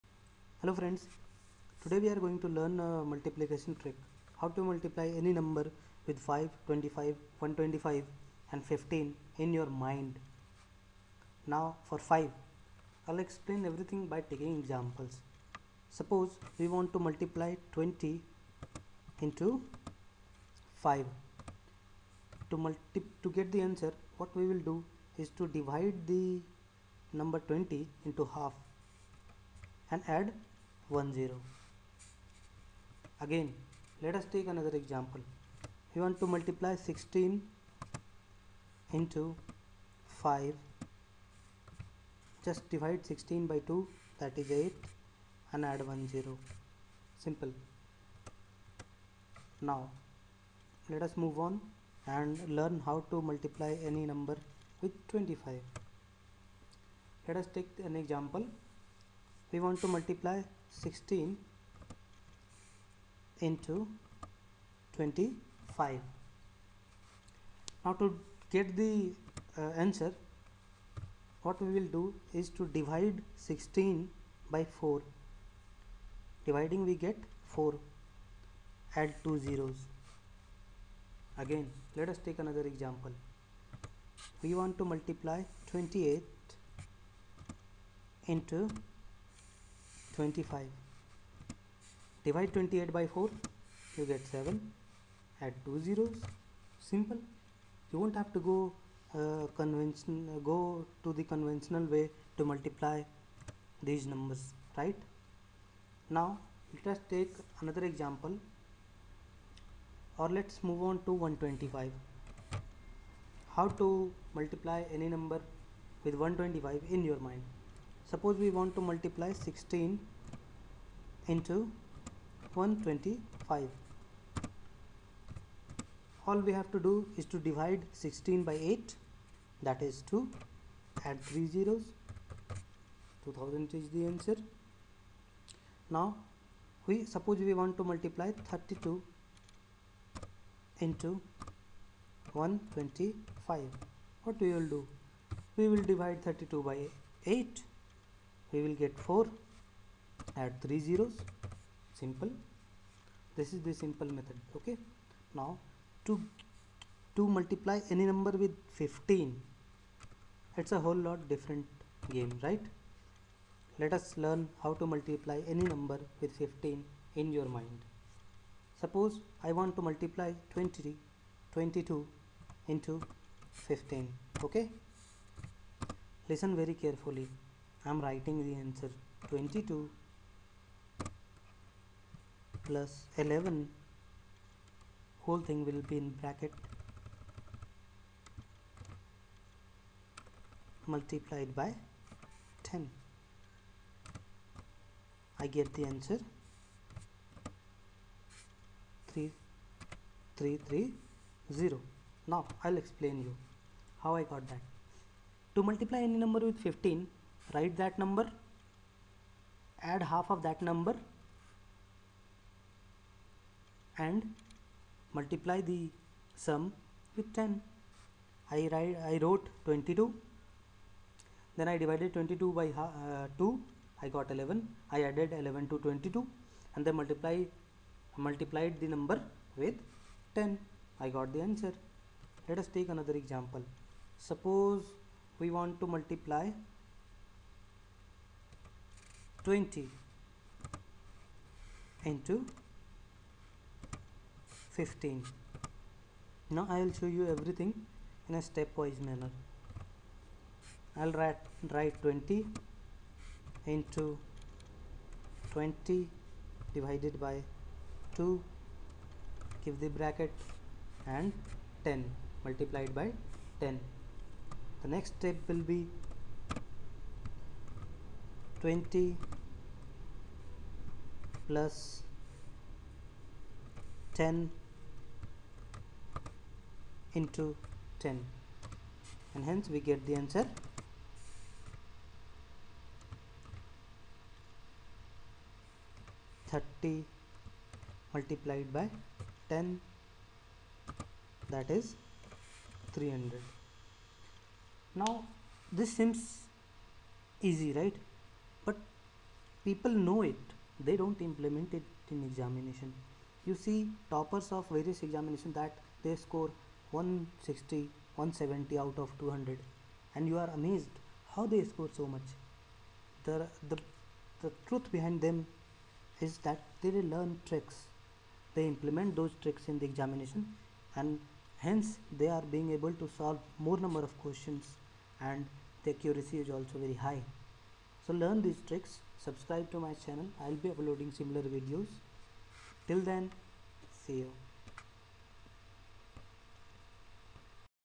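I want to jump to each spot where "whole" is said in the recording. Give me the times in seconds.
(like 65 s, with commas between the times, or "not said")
160 s, 185 s.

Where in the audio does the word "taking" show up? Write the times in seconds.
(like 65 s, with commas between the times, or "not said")
14 s.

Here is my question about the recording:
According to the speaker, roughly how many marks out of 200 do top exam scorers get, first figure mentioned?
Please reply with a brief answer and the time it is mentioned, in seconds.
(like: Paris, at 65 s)
160, at 306 s.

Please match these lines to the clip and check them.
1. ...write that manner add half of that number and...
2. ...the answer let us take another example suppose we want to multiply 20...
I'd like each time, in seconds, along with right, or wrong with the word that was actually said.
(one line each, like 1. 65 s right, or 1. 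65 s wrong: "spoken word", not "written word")
1. 207 s wrong: "number", not "manner"
2. 231 s right.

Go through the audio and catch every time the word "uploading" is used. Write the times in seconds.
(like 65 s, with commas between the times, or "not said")
330 s.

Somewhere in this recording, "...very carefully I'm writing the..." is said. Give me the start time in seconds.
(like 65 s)
176 s.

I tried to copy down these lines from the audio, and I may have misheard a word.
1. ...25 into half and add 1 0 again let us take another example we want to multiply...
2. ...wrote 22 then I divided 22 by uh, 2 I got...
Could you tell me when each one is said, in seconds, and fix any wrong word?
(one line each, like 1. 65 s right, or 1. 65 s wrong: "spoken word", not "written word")
1. 27 s wrong: "20", not "25"
2. 219 s right.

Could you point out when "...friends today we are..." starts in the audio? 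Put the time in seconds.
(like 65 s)
0 s.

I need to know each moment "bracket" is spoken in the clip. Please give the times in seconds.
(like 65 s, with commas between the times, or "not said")
186 s, 259 s.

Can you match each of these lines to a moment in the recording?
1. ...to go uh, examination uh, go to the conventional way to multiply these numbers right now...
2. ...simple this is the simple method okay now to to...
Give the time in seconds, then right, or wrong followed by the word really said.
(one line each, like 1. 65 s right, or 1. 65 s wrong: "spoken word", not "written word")
1. 98 s wrong: "convention", not "examination"
2. 151 s right.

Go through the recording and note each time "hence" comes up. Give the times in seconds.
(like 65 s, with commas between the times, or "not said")
279 s, 321 s.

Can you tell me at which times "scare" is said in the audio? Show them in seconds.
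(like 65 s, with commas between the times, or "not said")
not said.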